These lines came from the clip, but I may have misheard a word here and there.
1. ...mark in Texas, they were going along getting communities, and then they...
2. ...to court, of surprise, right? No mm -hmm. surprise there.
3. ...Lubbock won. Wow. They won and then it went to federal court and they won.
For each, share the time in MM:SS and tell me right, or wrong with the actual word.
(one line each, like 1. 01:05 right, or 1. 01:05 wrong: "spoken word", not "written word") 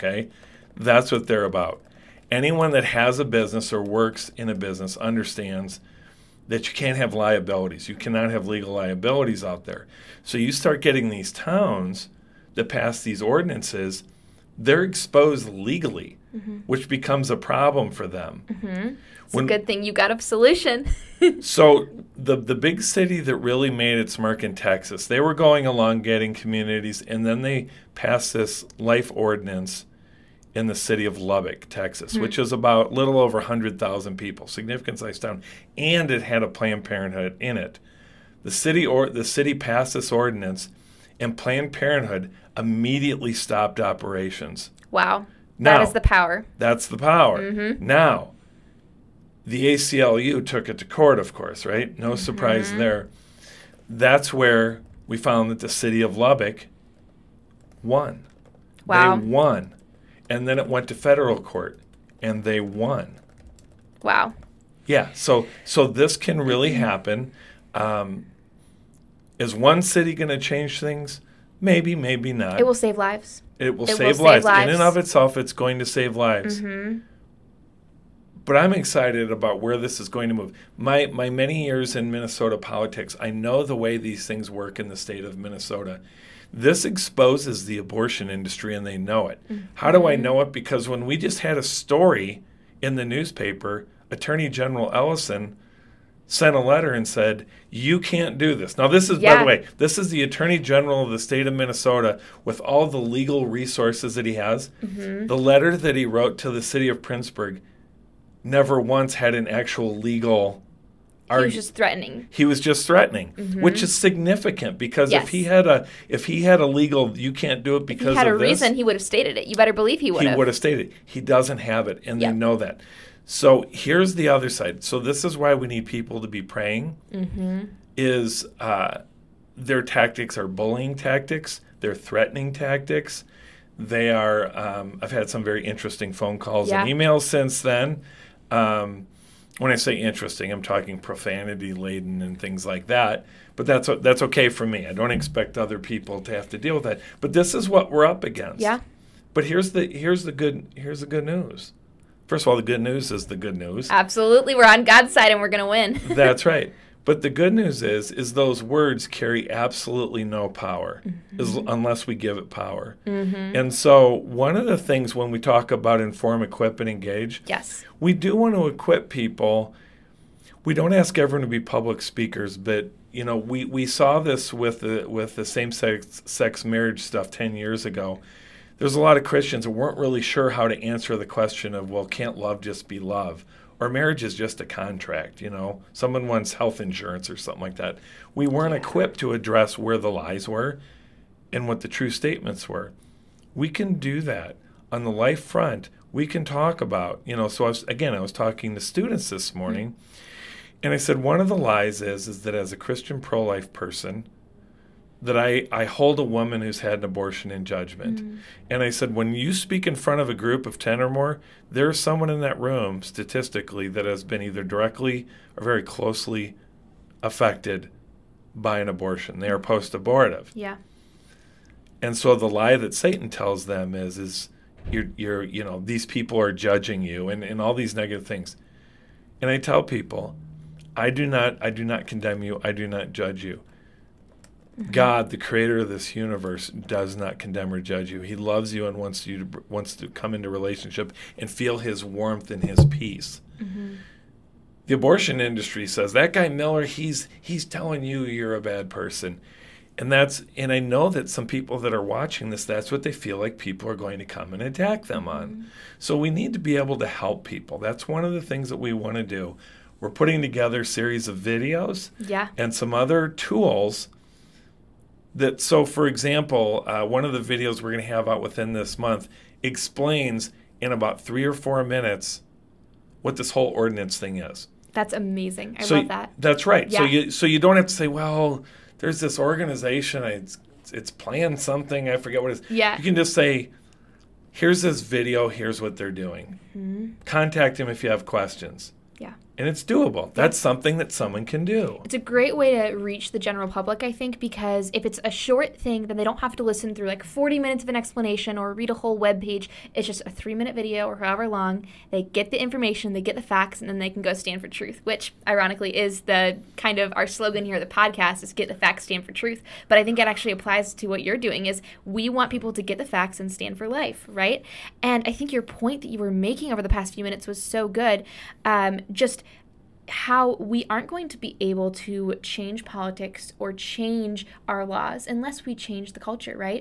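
1. 00:24 right
2. 00:50 wrong: "course", not "surprise"
3. 00:56 right.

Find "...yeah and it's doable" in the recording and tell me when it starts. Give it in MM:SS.
04:49.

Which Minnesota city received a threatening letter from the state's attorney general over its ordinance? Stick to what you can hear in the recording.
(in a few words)
Prinsburg.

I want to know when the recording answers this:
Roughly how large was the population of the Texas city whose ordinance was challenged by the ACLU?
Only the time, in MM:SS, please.
00:33.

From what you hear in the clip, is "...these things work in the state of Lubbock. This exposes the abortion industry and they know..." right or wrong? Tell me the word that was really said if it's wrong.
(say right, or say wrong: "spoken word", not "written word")
wrong: "Minnesota", not "Lubbock".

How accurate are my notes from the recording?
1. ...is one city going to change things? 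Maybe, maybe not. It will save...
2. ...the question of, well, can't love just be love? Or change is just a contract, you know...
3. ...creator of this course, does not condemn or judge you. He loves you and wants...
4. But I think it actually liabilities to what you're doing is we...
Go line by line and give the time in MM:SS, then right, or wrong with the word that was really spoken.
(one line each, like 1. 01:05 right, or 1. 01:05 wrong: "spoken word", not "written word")
1. 01:09 right
2. 03:01 wrong: "marriage", not "change"
3. 03:55 wrong: "universe", not "course"
4. 05:09 wrong: "applies", not "liabilities".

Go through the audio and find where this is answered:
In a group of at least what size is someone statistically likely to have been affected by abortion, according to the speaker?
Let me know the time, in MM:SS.
03:30.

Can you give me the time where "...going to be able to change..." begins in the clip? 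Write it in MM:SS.
05:21.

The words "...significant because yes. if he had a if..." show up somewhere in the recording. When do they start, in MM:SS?
01:53.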